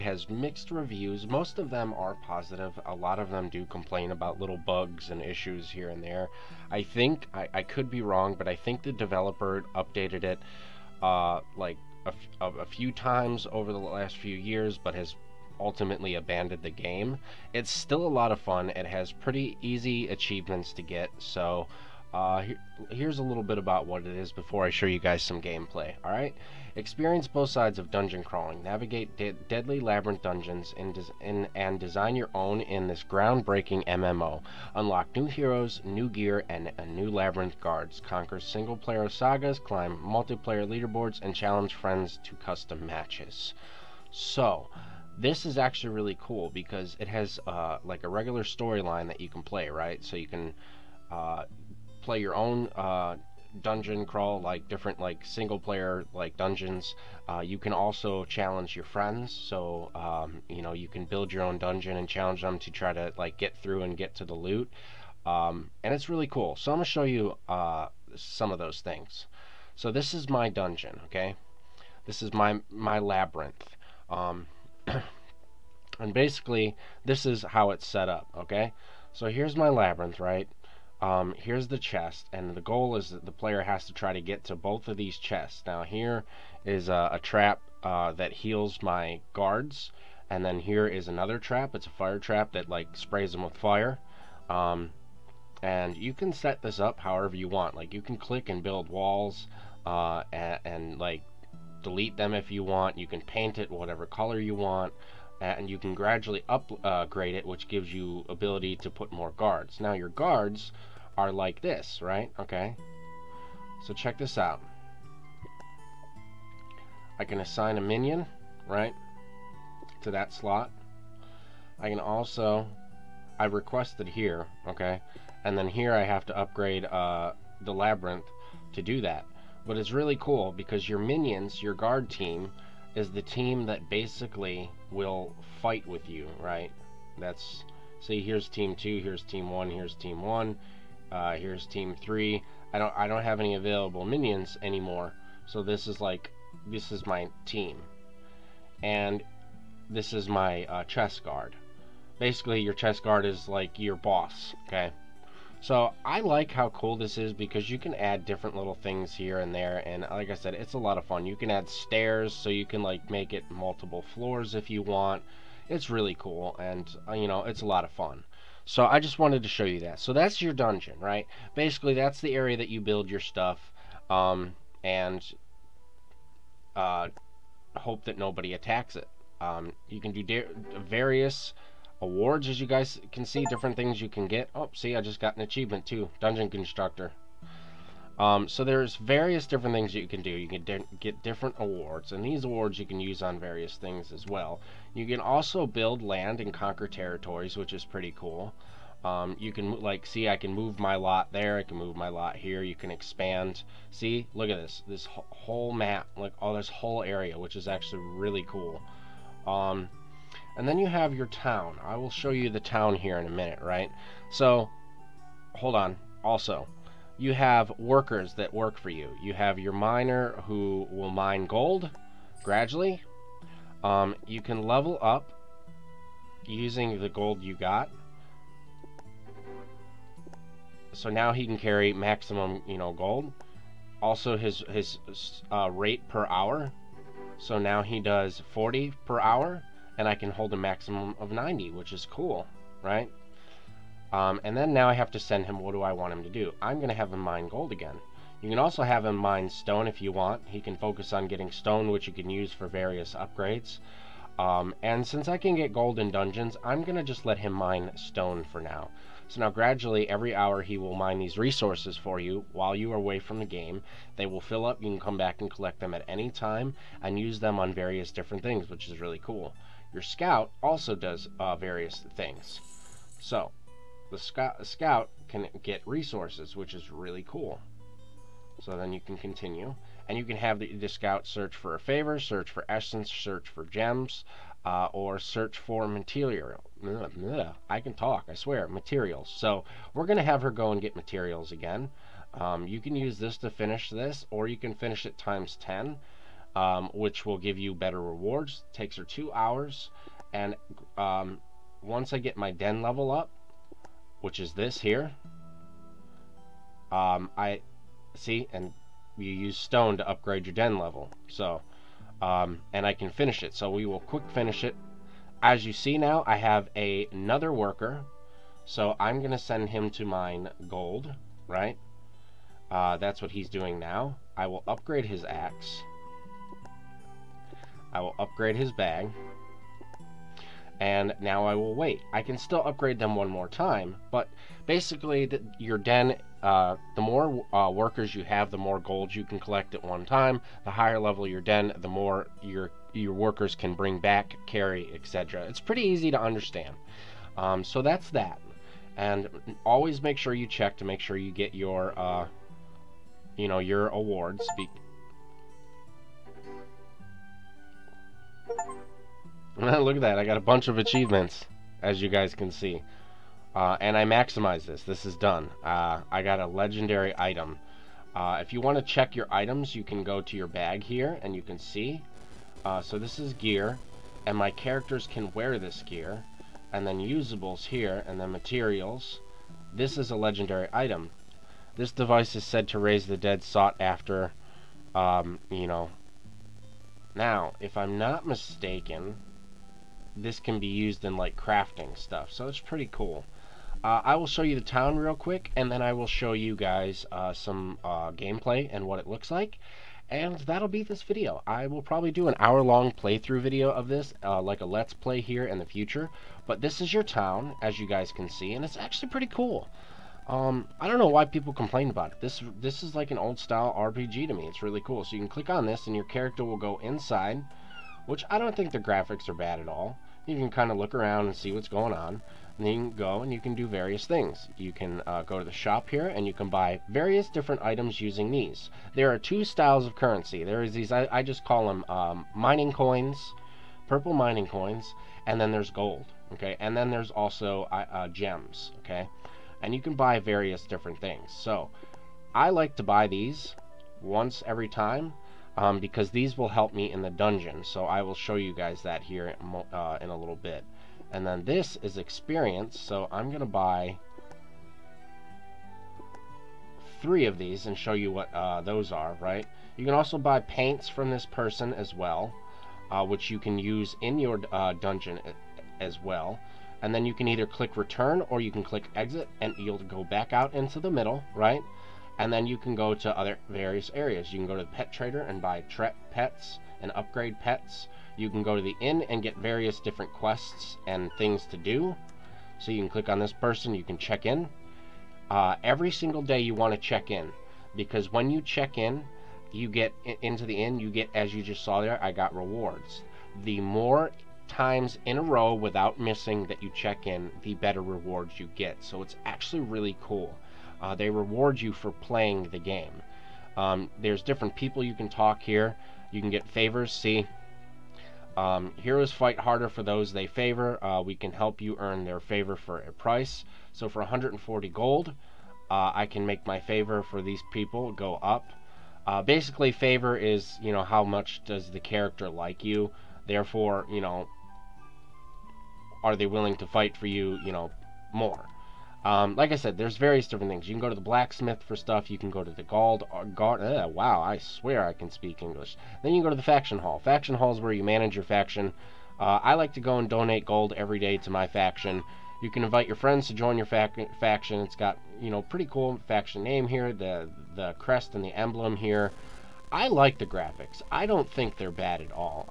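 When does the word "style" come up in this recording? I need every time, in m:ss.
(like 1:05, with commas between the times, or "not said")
6:53, 7:09.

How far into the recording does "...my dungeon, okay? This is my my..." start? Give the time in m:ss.
1:10.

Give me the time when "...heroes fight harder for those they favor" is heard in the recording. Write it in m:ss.
8:28.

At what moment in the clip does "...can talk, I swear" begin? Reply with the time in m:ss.
4:47.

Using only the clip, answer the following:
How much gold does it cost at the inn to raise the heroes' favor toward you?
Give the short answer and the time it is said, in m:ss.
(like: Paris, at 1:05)
140 gold, at 8:34.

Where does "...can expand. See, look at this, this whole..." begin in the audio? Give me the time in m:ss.
3:22.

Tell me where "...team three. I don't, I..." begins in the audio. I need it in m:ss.
2:21.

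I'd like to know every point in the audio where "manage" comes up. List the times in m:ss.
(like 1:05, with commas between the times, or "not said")
8:57.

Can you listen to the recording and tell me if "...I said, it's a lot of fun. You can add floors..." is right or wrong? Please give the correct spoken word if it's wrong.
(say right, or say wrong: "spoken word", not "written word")
wrong: "stairs", not "floors".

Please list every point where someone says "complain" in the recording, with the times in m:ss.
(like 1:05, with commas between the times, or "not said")
0:03, 6:51.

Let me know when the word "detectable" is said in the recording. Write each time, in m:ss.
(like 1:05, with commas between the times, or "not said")
not said.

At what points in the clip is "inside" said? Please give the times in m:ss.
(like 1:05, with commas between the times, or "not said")
6:56.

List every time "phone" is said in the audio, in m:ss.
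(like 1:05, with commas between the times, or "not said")
not said.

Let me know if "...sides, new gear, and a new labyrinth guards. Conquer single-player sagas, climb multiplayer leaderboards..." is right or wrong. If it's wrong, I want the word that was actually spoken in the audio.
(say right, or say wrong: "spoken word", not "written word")
wrong: "heroes", not "sides".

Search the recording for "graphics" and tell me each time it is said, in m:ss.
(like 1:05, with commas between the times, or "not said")
6:58, 9:10.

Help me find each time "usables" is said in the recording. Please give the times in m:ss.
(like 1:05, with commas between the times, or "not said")
6:17.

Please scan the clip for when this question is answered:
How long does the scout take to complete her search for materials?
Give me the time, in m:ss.
4:59.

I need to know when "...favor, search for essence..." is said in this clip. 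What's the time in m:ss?
4:41.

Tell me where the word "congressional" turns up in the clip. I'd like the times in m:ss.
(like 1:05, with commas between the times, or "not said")
not said.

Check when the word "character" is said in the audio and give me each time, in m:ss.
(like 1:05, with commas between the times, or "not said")
6:14, 6:56, 8:41.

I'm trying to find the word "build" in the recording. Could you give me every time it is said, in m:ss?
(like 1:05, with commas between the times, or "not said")
1:01, 1:38, 2:52, 3:15.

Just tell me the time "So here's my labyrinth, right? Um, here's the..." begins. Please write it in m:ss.
1:19.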